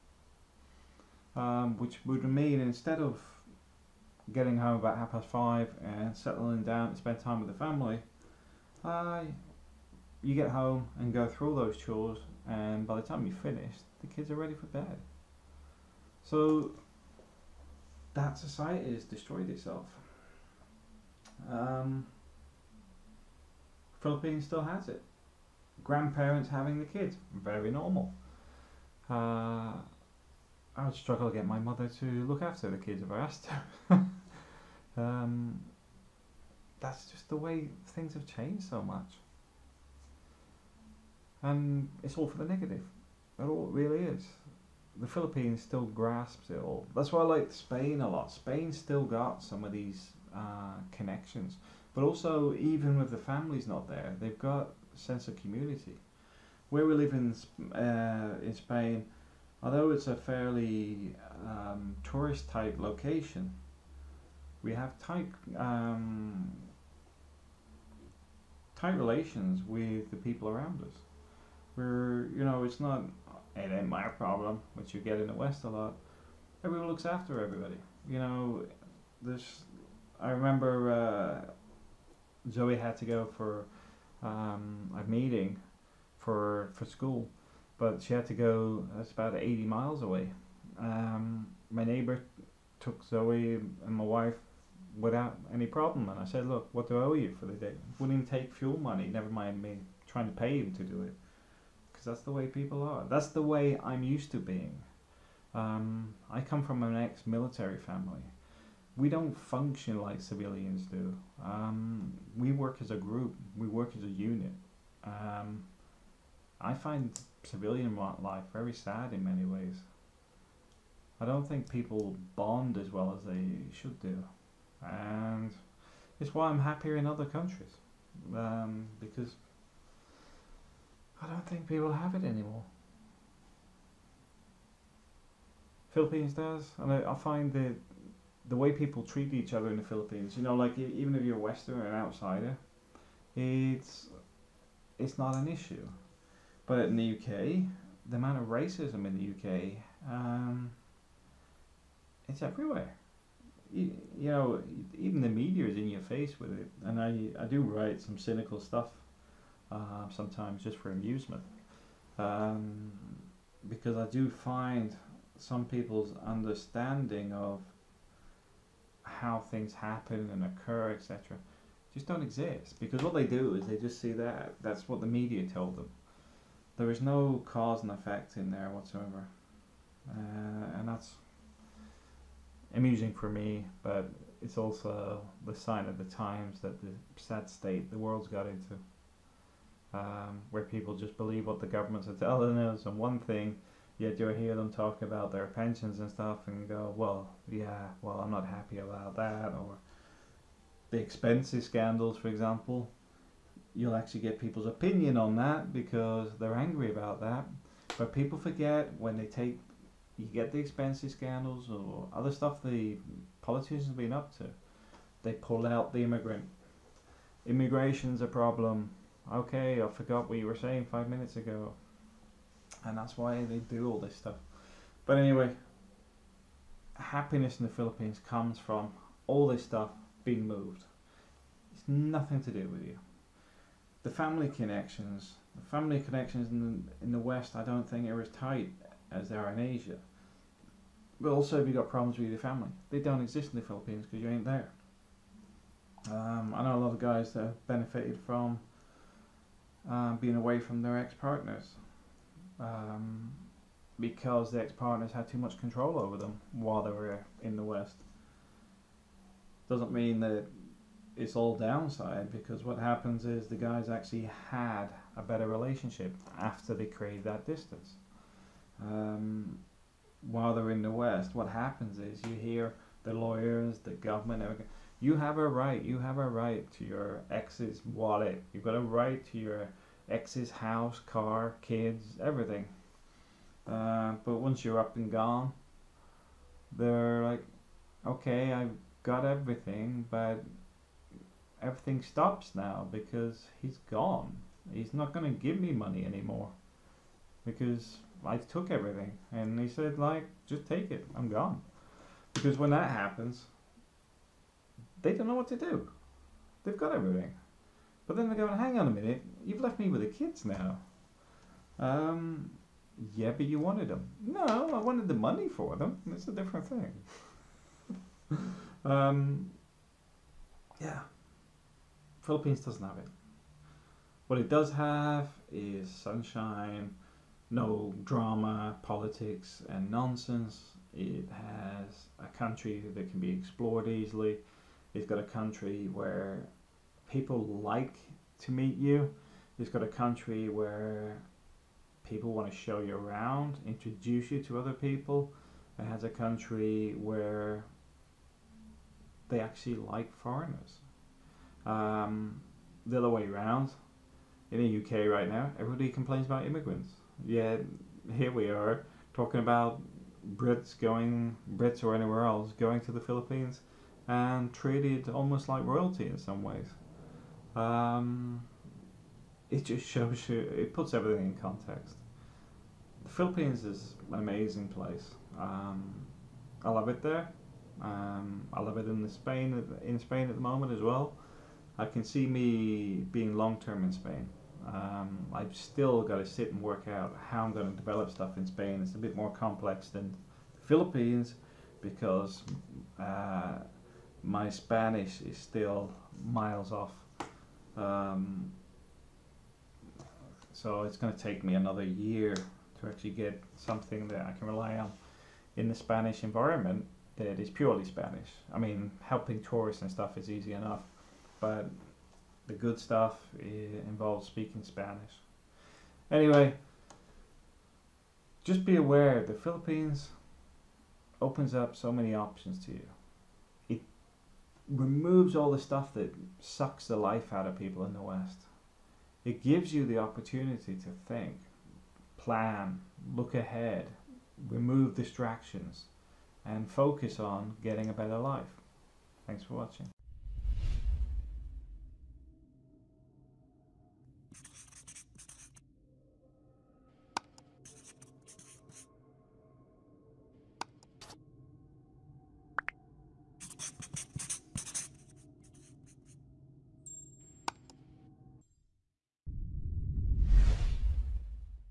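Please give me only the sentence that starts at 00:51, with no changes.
But also, even with the families not there, they've got sense of community.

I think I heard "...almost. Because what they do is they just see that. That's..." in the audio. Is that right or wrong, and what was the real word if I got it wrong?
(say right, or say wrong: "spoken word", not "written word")
wrong: "exist", not "almost".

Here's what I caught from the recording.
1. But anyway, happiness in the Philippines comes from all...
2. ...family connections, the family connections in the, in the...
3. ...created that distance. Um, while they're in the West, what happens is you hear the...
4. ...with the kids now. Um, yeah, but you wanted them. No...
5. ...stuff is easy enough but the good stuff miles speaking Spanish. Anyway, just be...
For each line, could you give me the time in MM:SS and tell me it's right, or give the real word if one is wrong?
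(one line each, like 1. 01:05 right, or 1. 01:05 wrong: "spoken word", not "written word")
1. 03:45 right
2. 03:54 right
3. 04:26 right
4. 05:09 right
5. 06:49 wrong: "involves", not "miles".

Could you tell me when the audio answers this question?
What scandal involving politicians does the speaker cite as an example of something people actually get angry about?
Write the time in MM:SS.
03:20.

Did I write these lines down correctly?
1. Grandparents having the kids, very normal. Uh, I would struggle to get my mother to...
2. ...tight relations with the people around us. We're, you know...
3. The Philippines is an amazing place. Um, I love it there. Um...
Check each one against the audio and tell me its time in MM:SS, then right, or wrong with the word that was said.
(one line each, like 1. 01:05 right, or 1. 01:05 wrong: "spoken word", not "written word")
1. 00:25 right
2. 01:08 right
3. 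06:13 right.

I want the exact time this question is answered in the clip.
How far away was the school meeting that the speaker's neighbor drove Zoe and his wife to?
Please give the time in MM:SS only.
01:29.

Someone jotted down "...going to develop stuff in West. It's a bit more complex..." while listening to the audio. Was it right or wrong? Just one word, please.
wrong.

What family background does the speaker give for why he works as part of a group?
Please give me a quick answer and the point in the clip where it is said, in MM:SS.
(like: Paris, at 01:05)
ex-military, at 01:46.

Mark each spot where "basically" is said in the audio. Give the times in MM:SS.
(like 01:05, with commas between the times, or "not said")
not said.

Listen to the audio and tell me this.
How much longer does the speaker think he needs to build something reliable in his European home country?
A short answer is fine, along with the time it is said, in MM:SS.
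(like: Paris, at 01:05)
another year, at 06:41.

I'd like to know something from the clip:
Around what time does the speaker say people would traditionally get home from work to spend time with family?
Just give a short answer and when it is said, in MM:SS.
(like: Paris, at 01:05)
half past five, at 00:04.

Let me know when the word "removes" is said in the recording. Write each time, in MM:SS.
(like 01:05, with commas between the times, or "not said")
07:04, 07:14.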